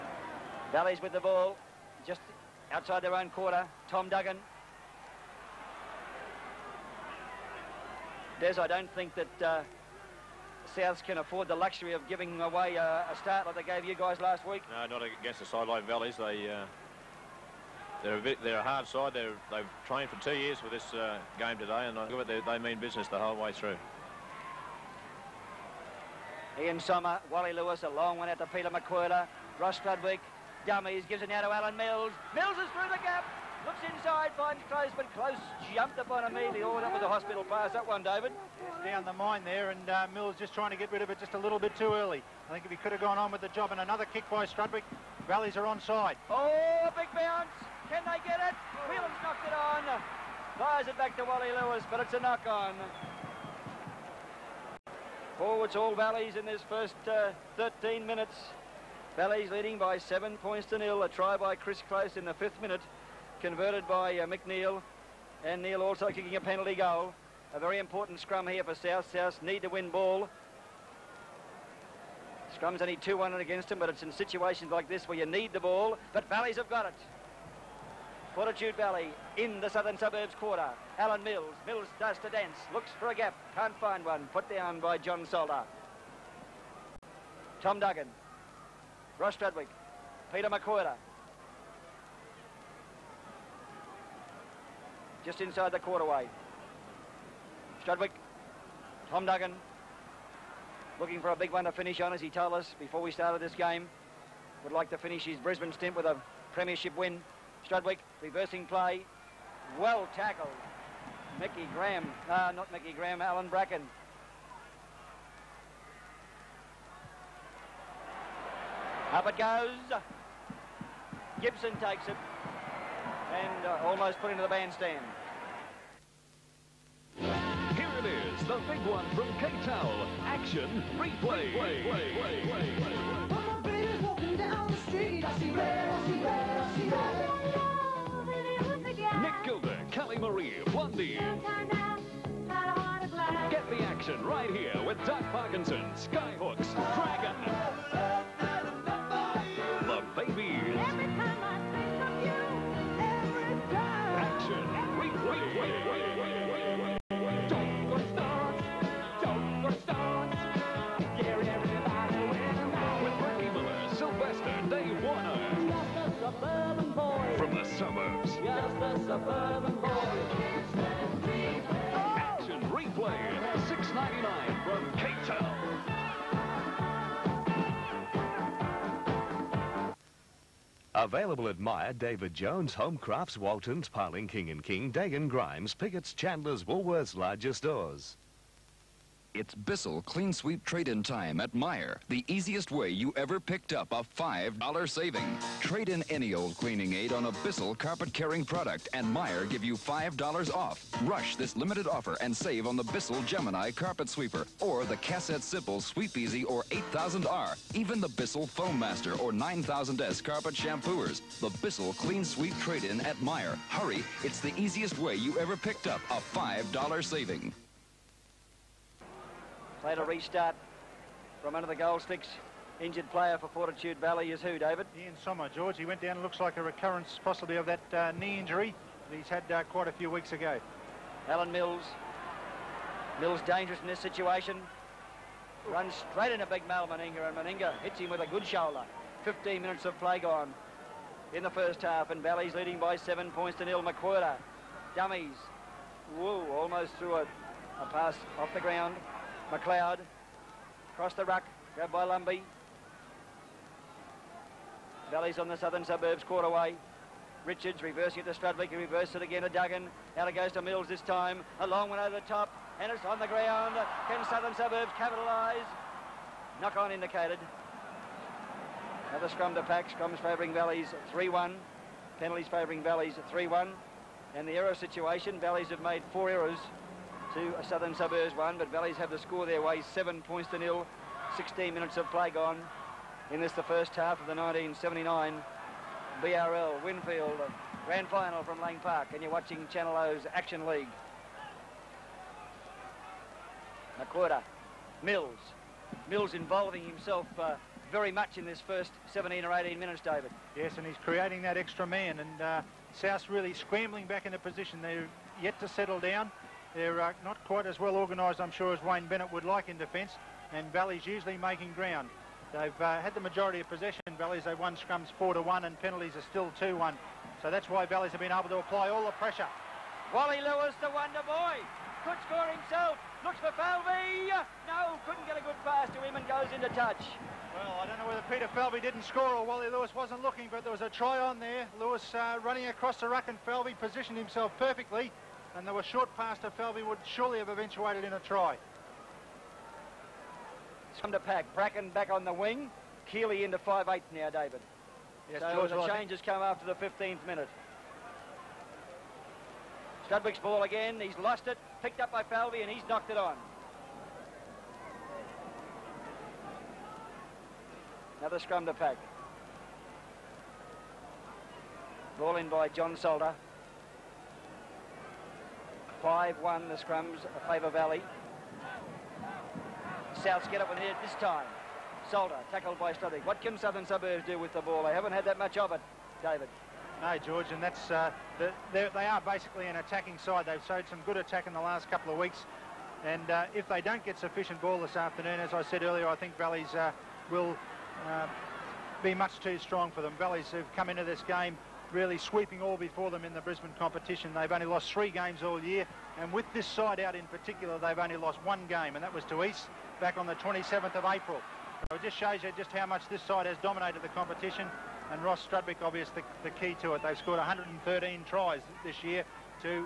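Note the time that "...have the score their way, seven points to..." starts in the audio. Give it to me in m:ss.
4:38.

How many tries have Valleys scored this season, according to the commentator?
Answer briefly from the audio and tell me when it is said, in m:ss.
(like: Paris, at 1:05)
113, at 6:47.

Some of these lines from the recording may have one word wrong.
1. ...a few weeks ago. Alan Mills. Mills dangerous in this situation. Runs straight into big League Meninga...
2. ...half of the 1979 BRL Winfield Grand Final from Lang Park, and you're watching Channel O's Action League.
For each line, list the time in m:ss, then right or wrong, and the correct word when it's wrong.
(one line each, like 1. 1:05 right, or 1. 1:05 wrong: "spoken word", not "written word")
1. 3:49 wrong: "Mal", not "League"
2. 4:43 right.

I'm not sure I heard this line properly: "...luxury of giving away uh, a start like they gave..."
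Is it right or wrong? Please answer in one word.
right.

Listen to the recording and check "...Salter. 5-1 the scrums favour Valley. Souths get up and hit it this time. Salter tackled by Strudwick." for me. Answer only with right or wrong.
right.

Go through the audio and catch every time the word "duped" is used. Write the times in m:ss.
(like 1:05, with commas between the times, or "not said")
not said.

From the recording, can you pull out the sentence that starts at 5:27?
Well, I don't know whether Peter Falvey didn't score or Wally Lewis wasn't looking, but there was a try on there.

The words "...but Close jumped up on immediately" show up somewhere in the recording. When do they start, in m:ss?
0:34.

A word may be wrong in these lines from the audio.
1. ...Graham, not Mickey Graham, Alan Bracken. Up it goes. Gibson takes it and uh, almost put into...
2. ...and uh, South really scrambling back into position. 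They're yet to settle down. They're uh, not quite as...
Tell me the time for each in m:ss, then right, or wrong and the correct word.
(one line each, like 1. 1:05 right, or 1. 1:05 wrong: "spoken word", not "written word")
1. 1:51 right
2. 5:02 right.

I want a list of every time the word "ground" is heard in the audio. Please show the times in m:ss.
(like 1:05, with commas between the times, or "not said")
4:08, 4:23, 5:11.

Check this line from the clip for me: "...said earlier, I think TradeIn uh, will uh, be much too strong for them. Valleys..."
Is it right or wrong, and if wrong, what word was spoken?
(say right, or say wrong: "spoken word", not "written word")
wrong: "Valleys", not "TradeIn".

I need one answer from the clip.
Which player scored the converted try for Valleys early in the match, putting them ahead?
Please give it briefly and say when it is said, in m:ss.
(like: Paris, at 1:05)
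Chris Close, at 1:01.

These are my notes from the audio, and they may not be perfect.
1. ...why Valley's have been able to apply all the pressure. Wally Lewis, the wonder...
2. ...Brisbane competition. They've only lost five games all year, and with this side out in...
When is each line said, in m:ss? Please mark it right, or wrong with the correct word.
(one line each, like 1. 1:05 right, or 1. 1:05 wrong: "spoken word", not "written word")
1. 5:17 right
2. 6:33 wrong: "three", not "five".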